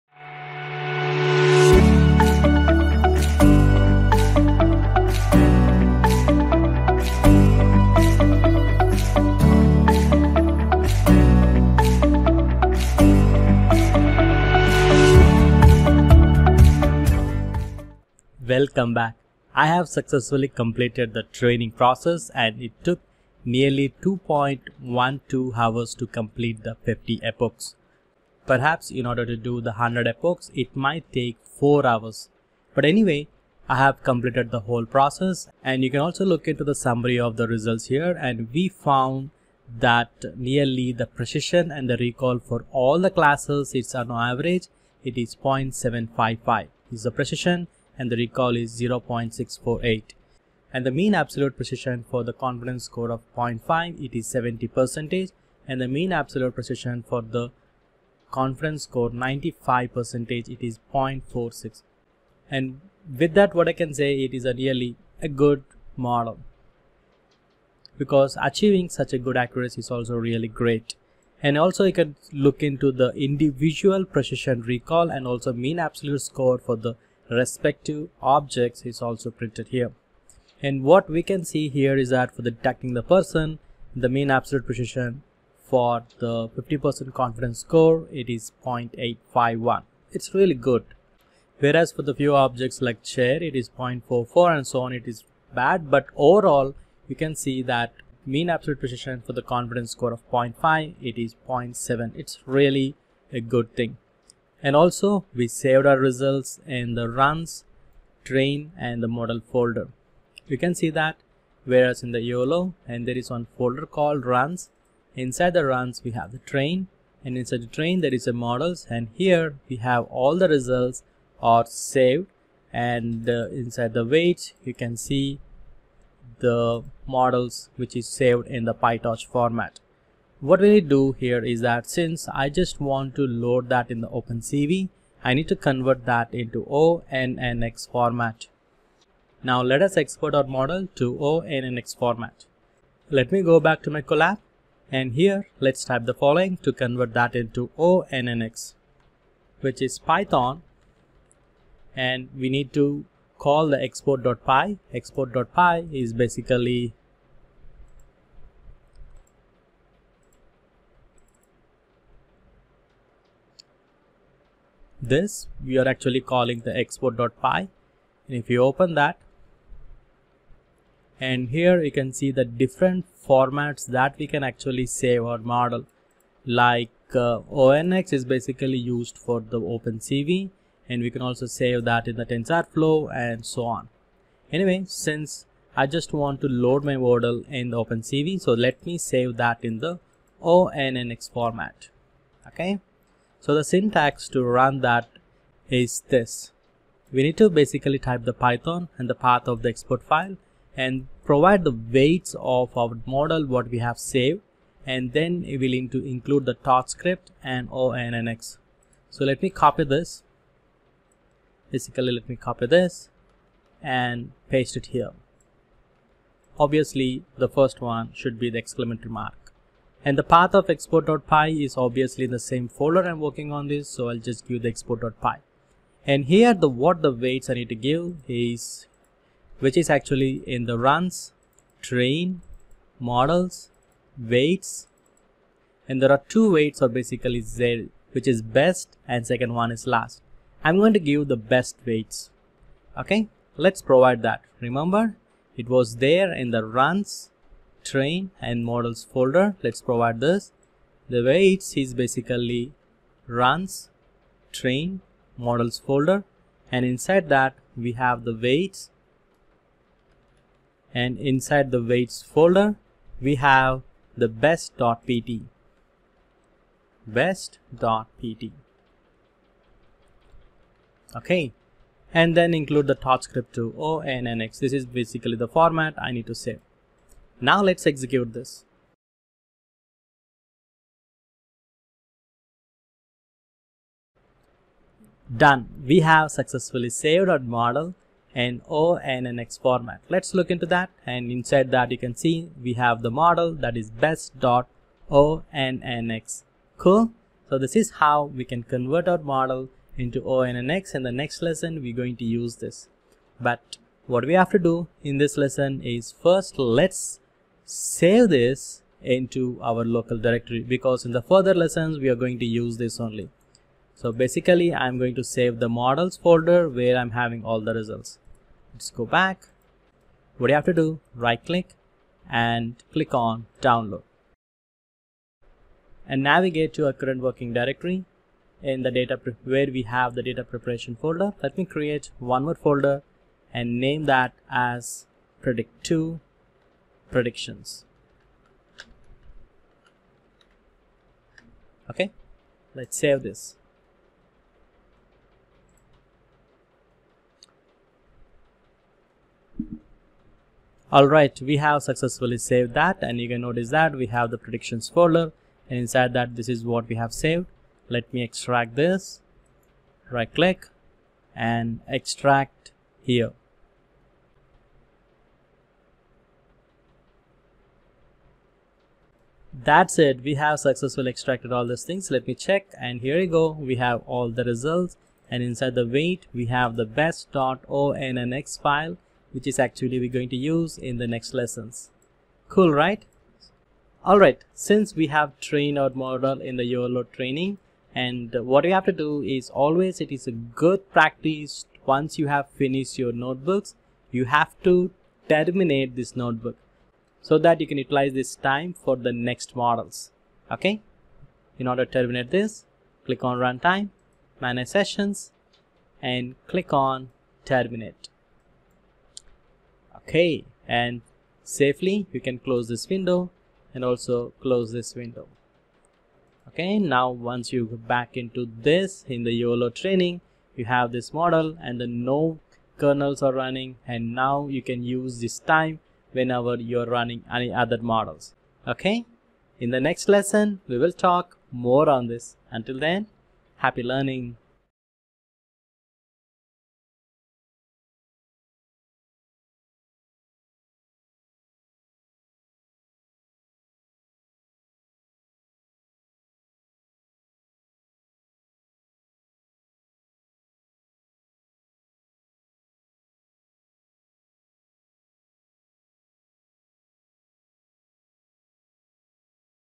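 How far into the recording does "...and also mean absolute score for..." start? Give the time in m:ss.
1:15.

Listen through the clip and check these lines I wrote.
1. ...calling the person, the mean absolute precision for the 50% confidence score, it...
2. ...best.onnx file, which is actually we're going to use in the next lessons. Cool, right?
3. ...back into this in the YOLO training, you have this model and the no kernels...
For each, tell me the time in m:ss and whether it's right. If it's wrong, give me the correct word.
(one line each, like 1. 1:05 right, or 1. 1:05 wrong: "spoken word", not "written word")
1. 1:22 wrong: "detecting", not "calling"
2. 6:16 right
3. 6:57 right.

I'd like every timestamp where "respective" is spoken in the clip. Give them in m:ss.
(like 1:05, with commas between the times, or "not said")
1:17.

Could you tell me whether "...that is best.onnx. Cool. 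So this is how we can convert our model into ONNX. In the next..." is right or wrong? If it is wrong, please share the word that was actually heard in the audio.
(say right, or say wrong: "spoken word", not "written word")
right.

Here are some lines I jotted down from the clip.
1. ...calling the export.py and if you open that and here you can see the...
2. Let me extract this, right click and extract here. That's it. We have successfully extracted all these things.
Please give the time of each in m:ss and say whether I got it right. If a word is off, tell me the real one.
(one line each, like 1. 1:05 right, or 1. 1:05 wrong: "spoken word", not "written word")
1. 2:46 right
2. 5:57 right.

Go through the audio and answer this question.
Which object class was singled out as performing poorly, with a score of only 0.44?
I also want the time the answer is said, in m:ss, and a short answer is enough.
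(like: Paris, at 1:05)
chair, at 1:33.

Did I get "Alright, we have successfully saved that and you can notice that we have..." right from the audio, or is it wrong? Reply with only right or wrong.
right.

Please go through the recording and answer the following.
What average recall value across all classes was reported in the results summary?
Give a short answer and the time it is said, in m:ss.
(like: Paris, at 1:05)
0.648, at 0:48.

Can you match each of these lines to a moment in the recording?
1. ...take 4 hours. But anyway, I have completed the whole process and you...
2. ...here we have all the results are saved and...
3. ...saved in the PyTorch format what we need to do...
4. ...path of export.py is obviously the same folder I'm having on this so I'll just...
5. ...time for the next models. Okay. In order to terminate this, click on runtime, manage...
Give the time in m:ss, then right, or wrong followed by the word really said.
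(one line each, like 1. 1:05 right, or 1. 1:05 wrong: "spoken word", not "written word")
1. 0:31 right
2. 1:59 right
3. 2:08 right
4. 3:40 wrong: "working", not "having"
5. 6:38 right.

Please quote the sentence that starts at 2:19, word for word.
Now let us export our model to ONNX format.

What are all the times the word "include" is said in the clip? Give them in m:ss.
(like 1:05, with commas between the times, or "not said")
3:26, 4:32.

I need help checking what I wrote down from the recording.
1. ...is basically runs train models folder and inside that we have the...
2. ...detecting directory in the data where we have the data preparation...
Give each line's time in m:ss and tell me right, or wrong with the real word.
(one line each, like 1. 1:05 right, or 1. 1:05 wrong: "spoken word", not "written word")
1. 4:11 right
2. 5:27 wrong: "working", not "detecting".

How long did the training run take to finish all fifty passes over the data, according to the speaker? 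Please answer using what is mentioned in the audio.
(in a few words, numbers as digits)
2.12 hours.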